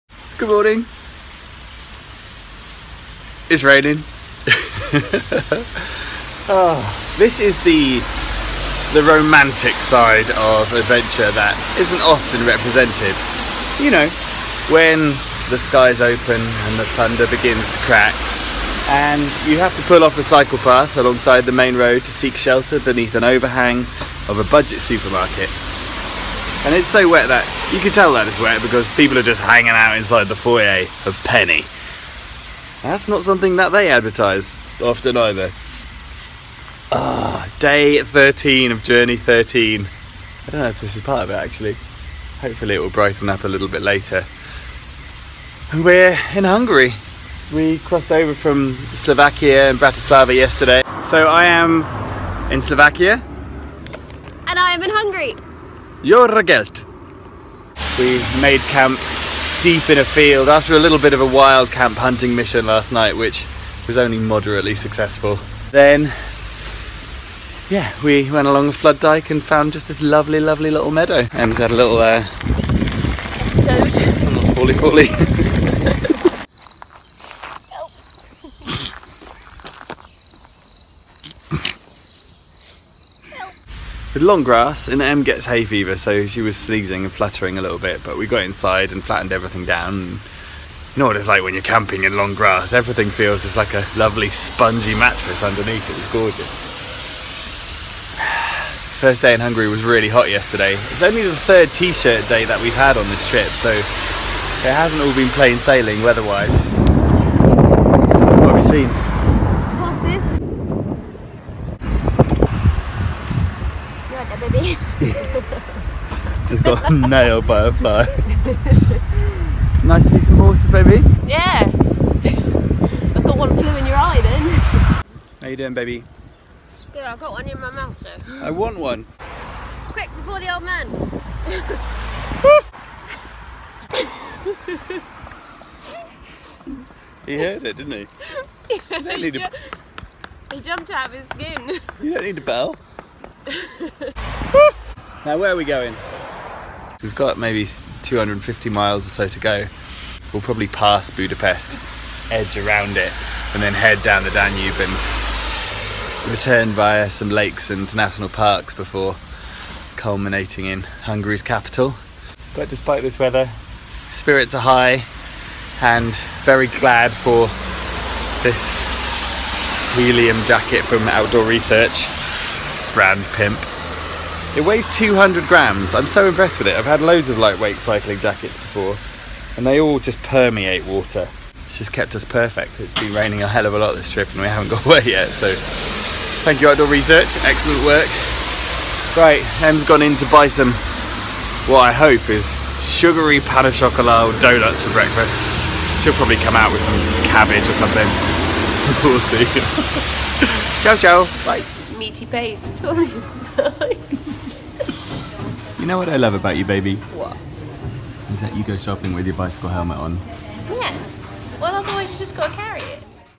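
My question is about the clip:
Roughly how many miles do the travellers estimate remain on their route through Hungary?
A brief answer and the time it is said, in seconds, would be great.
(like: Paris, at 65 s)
250, at 148 s.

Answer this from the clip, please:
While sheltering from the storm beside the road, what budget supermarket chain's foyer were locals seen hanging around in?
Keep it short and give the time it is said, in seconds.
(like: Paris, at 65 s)
Penny, at 31 s.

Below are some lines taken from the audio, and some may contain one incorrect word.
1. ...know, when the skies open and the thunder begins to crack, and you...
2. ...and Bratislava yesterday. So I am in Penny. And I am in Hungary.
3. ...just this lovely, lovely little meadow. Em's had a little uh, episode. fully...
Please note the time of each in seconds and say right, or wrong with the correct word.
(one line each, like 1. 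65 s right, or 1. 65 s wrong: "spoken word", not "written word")
1. 13 s right
2. 49 s wrong: "Slovakia", not "Penny"
3. 69 s right.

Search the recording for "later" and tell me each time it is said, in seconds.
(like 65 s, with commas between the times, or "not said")
43 s.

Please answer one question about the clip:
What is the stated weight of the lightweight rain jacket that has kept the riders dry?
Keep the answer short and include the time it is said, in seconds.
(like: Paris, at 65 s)
200 grams, at 174 s.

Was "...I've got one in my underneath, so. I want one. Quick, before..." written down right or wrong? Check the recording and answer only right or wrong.
wrong.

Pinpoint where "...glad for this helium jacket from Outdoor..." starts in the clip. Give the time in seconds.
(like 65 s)
166 s.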